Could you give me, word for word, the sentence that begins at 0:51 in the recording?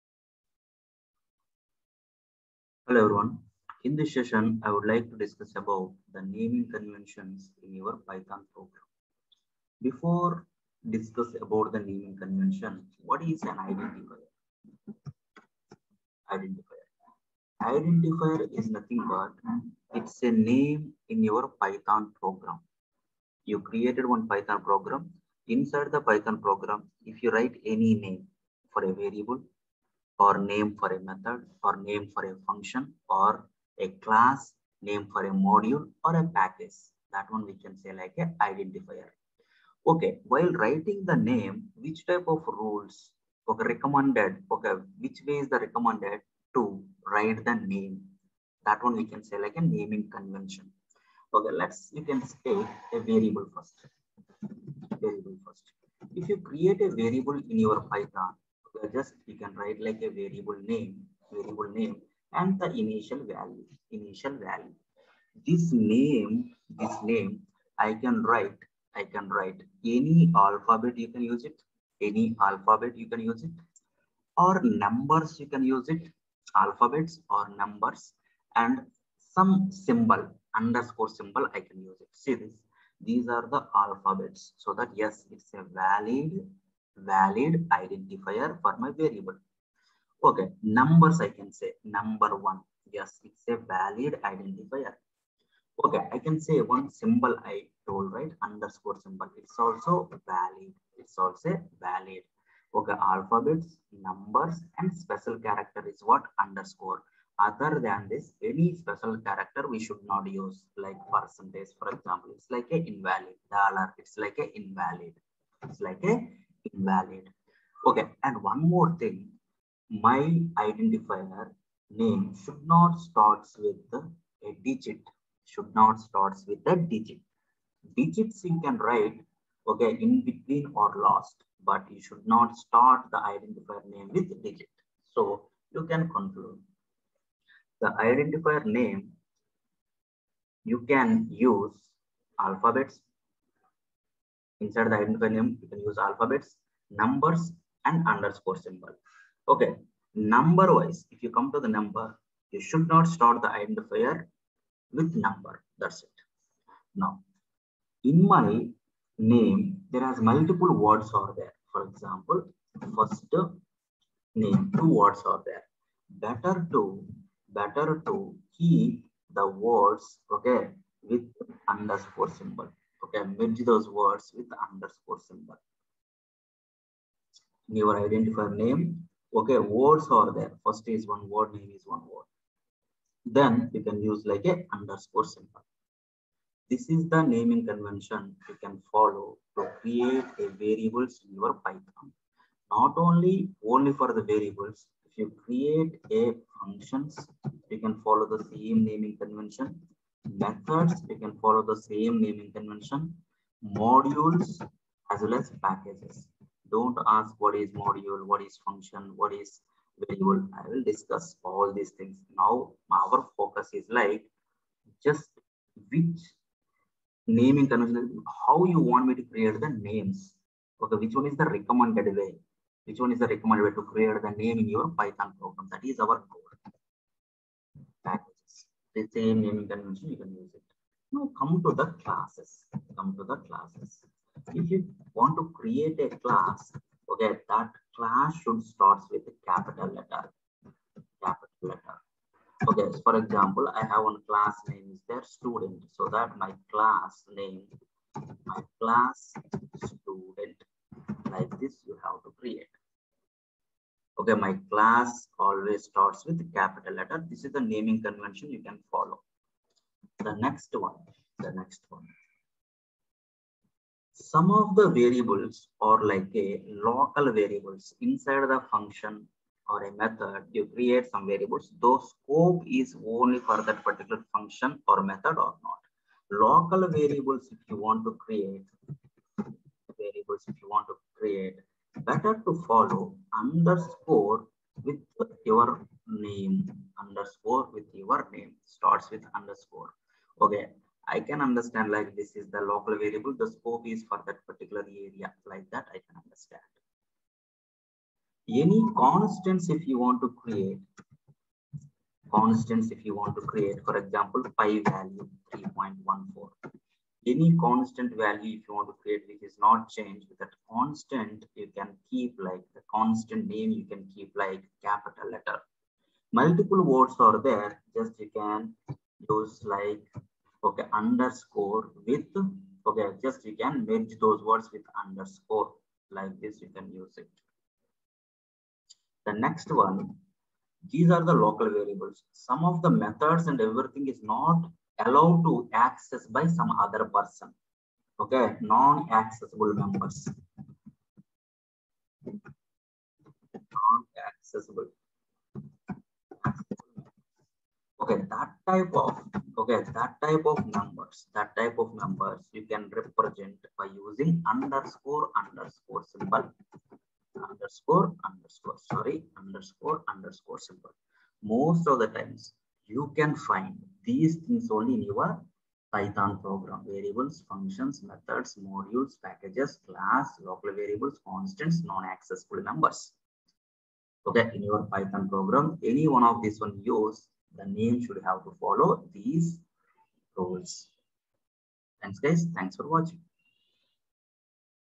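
Okay, let's, you can take a variable first.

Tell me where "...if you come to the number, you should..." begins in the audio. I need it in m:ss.
2:31.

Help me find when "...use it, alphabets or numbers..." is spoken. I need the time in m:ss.
1:15.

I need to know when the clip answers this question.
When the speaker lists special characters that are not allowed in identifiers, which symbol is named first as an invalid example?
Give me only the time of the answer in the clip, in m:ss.
1:51.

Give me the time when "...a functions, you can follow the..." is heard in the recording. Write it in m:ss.
3:16.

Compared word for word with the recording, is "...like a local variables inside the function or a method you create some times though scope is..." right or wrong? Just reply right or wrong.
wrong.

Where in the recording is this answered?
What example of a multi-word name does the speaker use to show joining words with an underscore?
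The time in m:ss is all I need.
2:42.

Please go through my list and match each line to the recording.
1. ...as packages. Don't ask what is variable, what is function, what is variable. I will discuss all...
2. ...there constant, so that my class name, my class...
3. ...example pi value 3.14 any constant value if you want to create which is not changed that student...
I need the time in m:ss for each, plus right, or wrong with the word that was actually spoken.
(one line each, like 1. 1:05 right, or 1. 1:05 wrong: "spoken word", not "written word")
1. 3:25 wrong: "module", not "variable"
2. 4:05 wrong: "student", not "constant"
3. 5:03 wrong: "constant", not "student".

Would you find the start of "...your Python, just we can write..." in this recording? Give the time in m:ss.
0:57.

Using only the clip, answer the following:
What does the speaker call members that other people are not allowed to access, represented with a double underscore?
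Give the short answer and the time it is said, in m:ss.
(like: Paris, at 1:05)
non-accessible members, at 5:38.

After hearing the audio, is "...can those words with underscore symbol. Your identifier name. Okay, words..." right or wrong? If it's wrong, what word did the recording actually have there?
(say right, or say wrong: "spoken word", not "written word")
right.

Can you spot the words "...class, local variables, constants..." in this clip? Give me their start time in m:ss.
6:09.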